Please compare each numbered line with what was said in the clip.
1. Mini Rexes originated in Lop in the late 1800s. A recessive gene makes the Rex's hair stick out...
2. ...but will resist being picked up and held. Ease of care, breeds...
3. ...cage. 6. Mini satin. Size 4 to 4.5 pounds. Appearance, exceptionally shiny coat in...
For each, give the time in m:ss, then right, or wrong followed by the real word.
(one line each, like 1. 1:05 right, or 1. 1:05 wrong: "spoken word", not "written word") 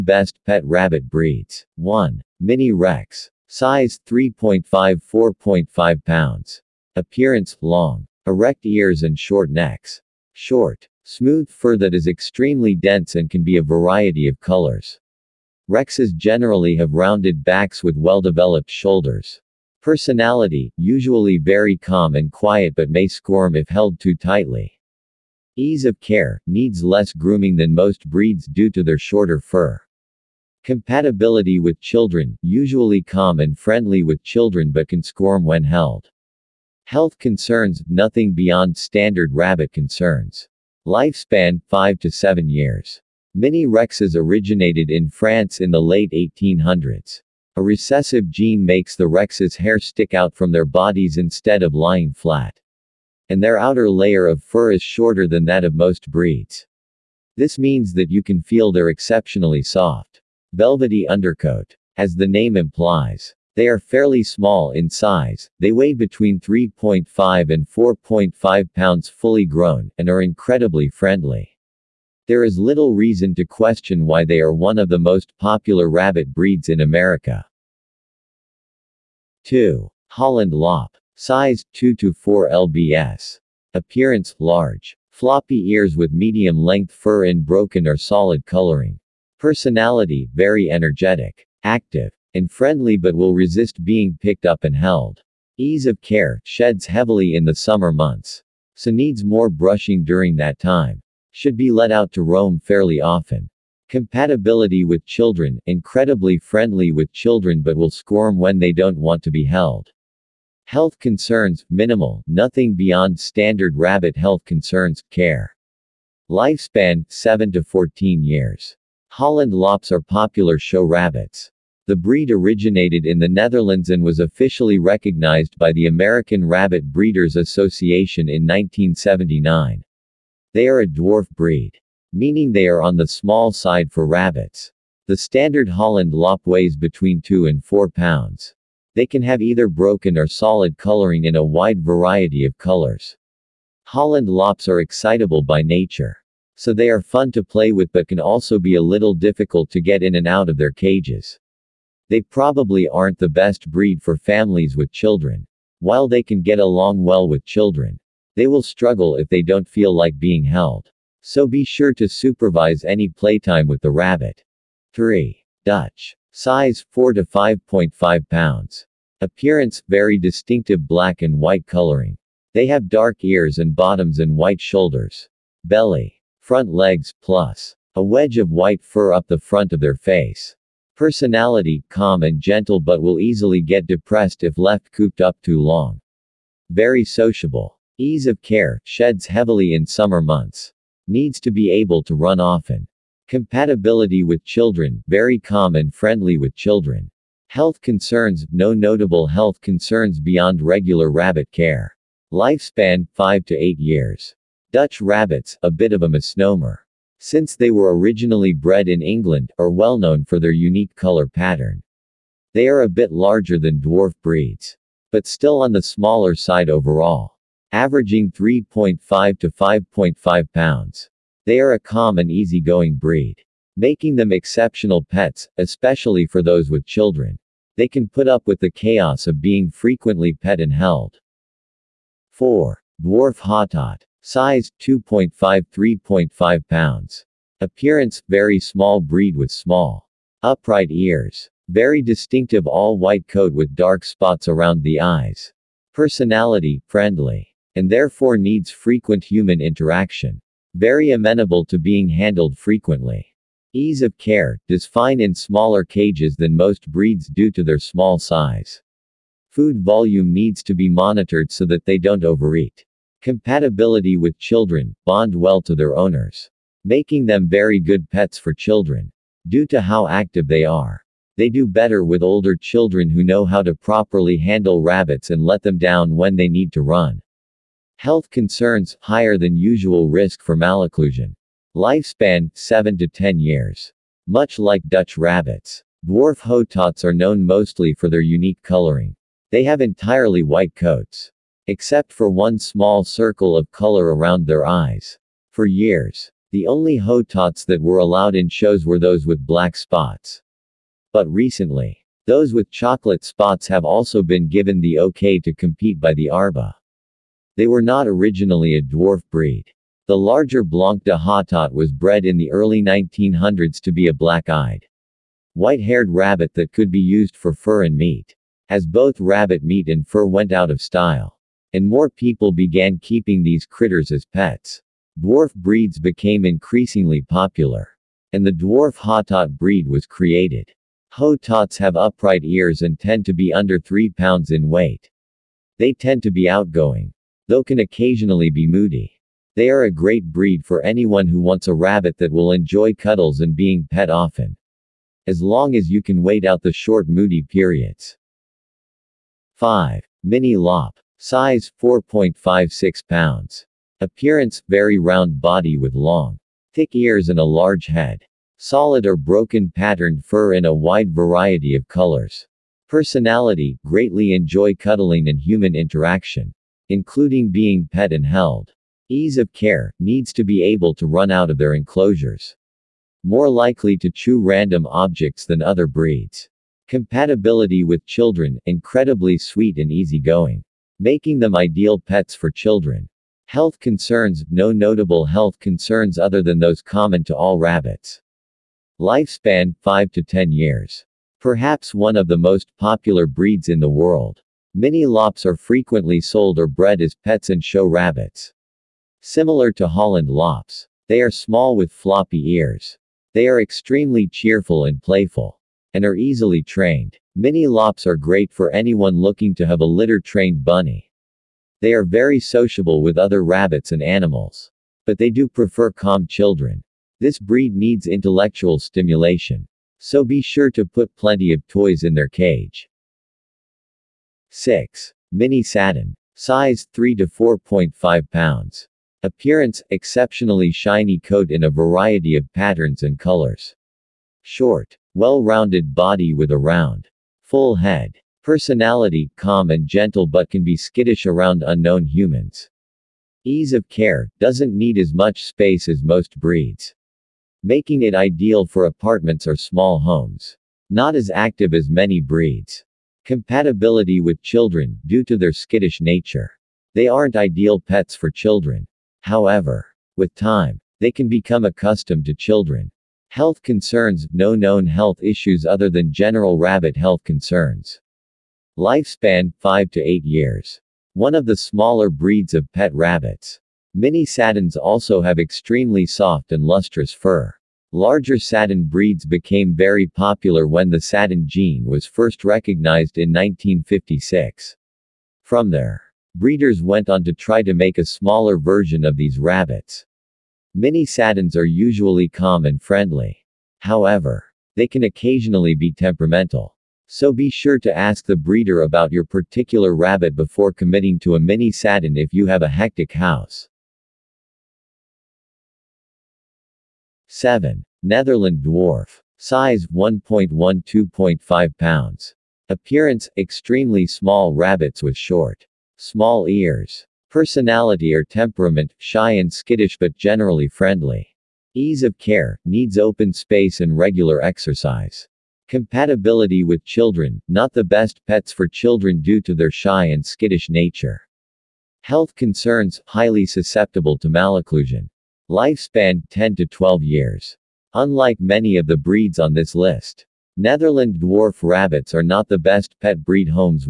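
1. 0:43 wrong: "France", not "Lop"
2. 1:32 wrong: "sheds", not "breeds"
3. 7:02 wrong: "3", not "4".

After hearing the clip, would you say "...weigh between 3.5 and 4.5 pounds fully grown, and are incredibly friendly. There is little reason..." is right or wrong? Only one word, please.
right.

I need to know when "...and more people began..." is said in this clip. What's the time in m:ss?
5:21.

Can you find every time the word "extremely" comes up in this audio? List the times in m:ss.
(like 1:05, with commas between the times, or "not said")
0:12, 6:43, 7:55, 8:33.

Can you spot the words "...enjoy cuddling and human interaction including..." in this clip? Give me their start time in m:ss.
6:04.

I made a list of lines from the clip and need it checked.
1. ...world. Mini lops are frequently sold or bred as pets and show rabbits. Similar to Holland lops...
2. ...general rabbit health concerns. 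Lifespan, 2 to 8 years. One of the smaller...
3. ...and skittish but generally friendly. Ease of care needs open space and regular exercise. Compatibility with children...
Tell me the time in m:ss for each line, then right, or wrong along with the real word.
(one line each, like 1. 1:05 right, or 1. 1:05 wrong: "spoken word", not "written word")
1. 6:33 right
2. 7:46 wrong: "5", not "2"
3. 8:39 right.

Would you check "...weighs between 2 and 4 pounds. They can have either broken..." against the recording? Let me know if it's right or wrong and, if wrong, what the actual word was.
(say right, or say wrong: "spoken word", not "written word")
right.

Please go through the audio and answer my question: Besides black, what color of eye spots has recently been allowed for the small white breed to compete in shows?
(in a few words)
Chocolate.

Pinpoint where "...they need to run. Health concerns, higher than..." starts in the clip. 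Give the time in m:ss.
4:36.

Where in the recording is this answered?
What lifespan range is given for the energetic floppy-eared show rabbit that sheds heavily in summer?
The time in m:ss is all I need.
1:57.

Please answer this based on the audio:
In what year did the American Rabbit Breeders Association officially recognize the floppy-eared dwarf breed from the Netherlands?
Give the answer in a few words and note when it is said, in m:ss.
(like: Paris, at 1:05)
1979, at 2:08.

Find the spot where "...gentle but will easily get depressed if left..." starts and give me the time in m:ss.
3:02.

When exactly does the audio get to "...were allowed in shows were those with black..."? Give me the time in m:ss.
4:57.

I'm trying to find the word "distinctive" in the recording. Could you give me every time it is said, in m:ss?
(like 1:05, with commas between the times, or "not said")
2:50, 4:02.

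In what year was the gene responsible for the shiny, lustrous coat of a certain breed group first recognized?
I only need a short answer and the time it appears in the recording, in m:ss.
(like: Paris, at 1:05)
1956, at 8:03.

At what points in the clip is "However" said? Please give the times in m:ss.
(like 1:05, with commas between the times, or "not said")
7:39, 8:13.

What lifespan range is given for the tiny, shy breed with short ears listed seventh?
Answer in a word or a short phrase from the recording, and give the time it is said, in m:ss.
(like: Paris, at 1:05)
10 to 12 years, at 8:56.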